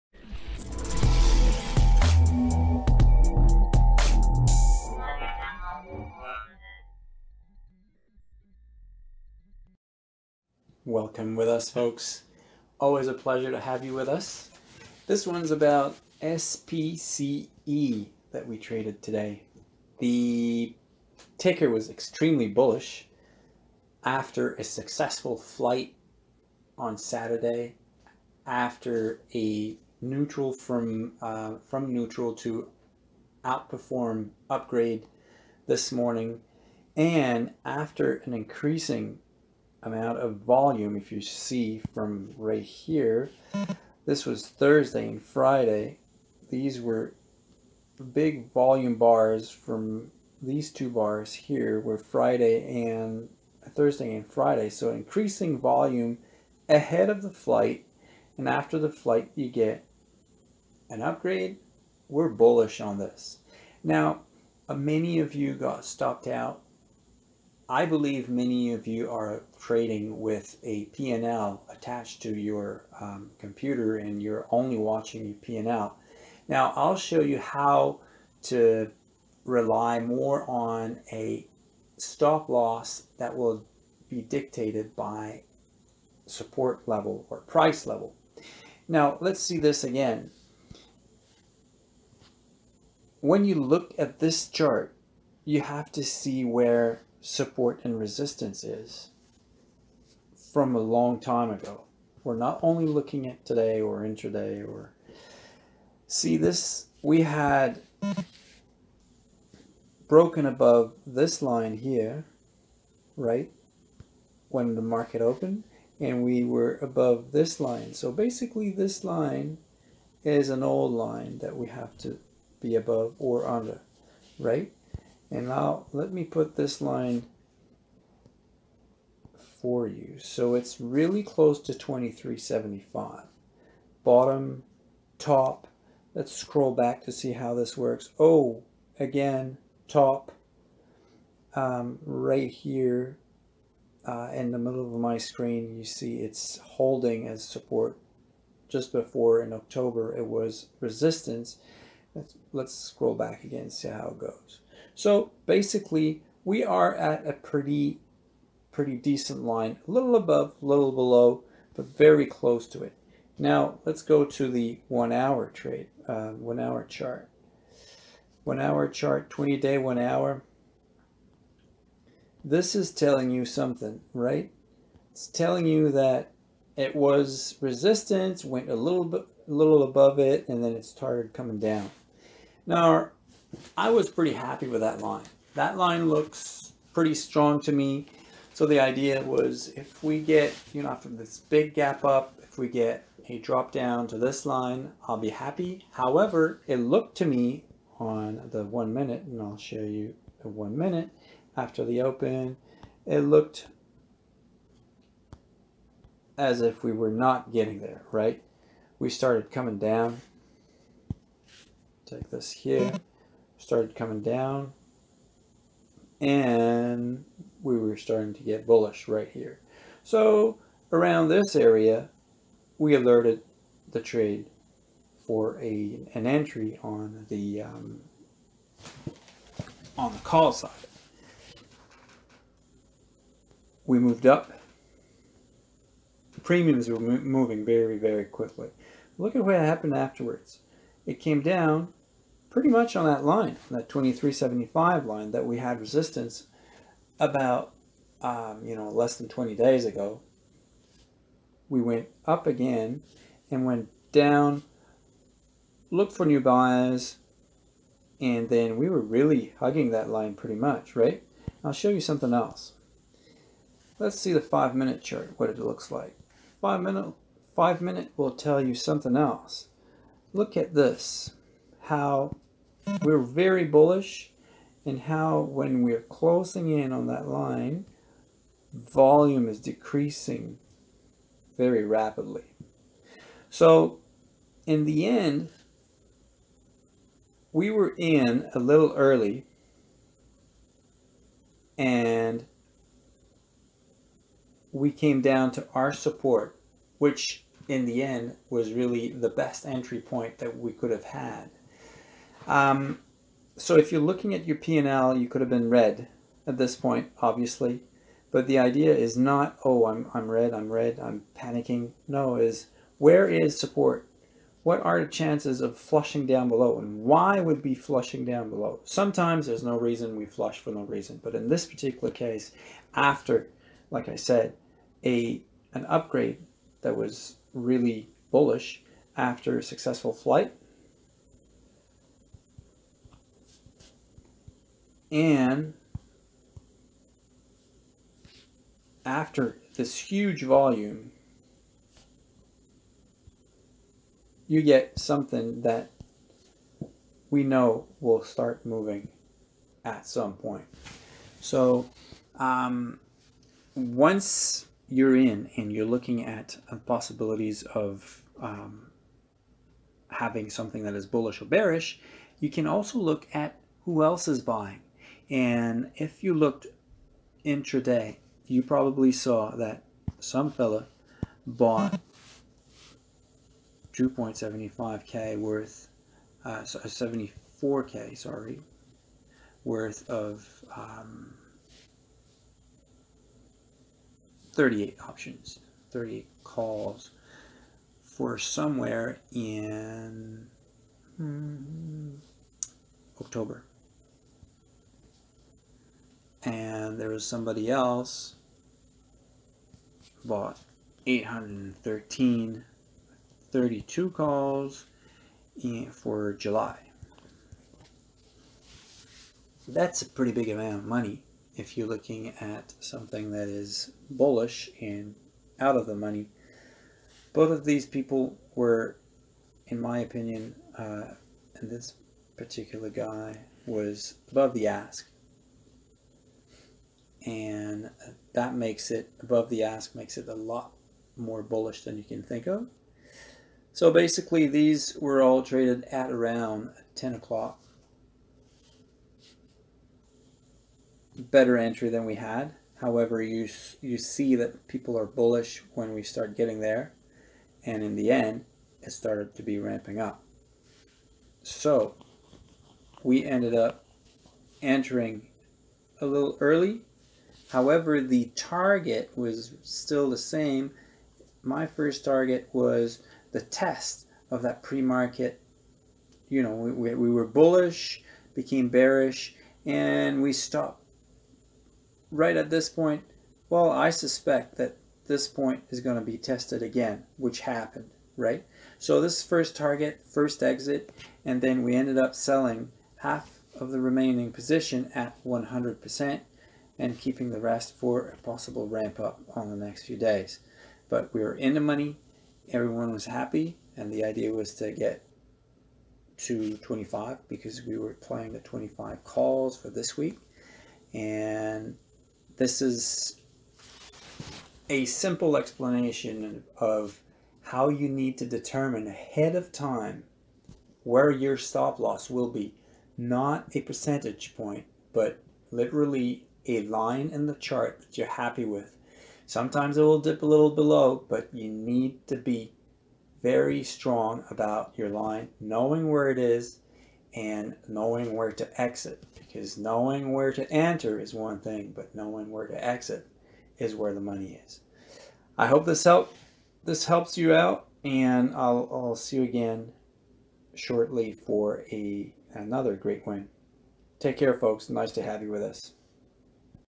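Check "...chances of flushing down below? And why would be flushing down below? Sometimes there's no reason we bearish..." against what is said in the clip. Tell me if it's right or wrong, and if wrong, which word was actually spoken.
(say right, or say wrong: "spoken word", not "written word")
wrong: "flush", not "bearish".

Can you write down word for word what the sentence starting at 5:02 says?
Um, so if you're looking at your P&L, you could have been red at this point, obviously.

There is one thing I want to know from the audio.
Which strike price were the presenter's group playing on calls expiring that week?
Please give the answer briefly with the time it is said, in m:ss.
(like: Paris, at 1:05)
25, at 8:18.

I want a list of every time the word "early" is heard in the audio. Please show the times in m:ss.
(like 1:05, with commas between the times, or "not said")
4:48, 7:36.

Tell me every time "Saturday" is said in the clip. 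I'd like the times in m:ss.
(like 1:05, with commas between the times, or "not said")
0:26.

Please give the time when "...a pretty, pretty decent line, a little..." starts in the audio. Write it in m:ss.
2:37.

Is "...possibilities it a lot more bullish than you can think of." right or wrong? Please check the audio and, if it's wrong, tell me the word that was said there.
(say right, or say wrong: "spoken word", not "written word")
wrong: "makes", not "possibilities".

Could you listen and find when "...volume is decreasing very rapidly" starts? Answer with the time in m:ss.
4:38.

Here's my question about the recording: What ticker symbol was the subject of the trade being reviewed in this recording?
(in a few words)
SPCE.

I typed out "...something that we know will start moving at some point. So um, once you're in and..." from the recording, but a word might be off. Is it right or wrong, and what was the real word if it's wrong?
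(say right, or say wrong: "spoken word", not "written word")
right.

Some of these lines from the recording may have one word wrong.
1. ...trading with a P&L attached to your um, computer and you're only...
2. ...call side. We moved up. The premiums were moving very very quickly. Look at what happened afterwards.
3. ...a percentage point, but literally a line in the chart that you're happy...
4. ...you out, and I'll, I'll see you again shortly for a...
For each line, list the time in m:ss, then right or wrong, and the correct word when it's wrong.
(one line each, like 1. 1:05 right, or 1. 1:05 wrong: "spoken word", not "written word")
1. 1:09 right
2. 3:50 right
3. 8:33 right
4. 8:57 right.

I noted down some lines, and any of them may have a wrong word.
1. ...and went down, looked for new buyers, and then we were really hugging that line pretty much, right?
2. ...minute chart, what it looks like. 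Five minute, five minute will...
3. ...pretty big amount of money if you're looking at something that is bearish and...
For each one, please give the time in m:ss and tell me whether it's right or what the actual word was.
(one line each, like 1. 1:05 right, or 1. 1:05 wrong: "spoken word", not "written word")
1. 4:13 right
2. 4:24 right
3. 6:50 wrong: "bullish", not "bearish".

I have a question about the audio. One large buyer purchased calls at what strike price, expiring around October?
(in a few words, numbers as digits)
38.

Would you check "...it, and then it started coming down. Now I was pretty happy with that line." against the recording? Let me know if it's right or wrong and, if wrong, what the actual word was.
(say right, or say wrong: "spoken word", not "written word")
right.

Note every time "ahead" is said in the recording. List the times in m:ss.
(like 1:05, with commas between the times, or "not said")
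0:56, 8:28.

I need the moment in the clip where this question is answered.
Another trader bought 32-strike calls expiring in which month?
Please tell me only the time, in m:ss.
6:46.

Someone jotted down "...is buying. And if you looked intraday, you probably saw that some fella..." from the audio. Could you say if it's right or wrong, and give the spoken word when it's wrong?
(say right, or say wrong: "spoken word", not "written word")
right.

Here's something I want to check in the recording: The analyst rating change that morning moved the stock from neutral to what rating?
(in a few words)
outperform.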